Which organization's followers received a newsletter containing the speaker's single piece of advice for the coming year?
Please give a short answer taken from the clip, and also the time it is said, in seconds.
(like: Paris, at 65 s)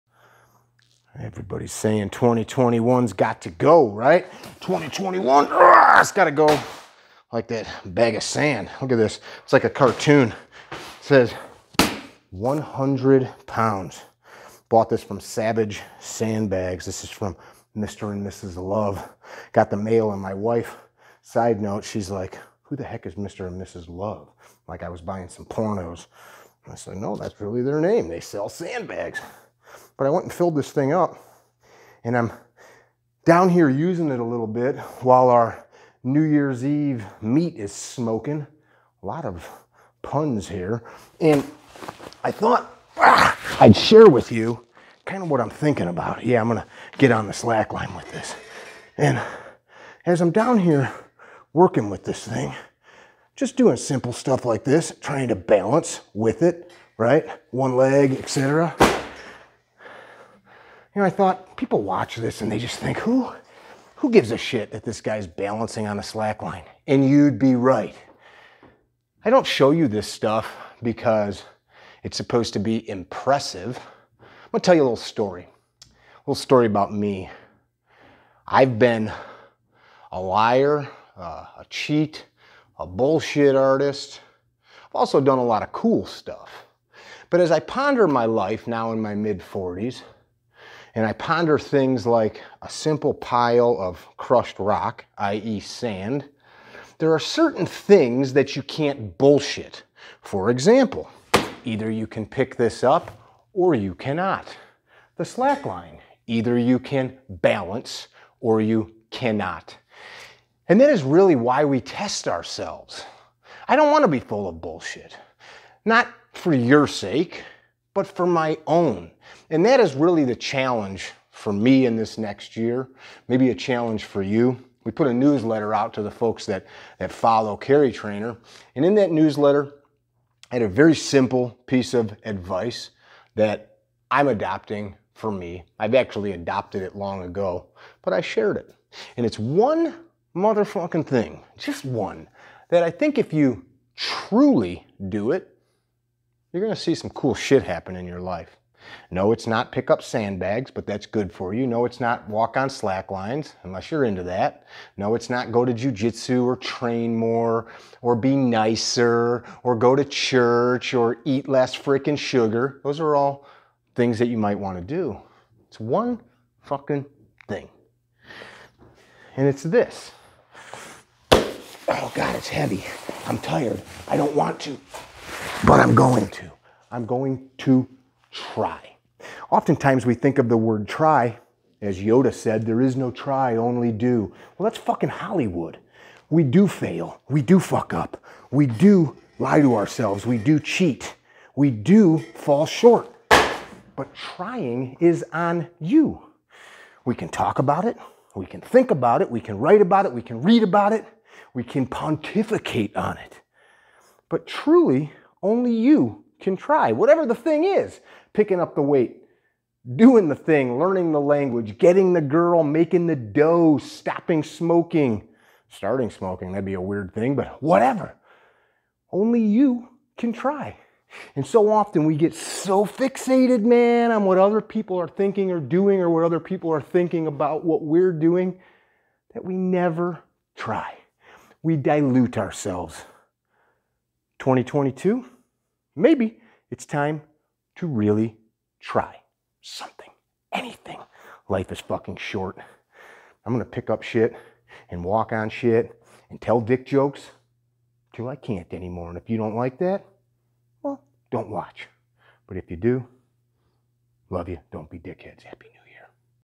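Carry Trainer, at 127 s.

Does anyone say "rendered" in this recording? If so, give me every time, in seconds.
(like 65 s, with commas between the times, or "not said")
not said.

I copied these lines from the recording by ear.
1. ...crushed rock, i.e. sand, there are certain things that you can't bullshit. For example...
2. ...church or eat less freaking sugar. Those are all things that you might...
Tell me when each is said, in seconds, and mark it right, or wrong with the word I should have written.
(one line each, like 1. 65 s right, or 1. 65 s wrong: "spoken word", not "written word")
1. 94 s right
2. 160 s right.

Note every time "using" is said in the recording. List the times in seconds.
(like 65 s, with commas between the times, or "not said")
33 s.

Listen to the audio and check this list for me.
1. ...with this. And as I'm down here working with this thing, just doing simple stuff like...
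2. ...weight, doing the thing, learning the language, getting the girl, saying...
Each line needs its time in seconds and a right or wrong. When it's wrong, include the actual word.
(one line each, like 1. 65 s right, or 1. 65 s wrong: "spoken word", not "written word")
1. 47 s right
2. 208 s wrong: "making", not "saying".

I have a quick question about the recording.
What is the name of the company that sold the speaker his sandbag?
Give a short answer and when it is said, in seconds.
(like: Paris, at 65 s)
Savage Sandbags, at 15 s.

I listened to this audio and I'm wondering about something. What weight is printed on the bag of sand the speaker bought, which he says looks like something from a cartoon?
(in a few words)
100 pounds.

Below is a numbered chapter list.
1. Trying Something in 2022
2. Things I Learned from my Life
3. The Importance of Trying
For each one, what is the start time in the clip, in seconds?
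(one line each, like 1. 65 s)
1. 234 s
2. 45 s
3. 171 s.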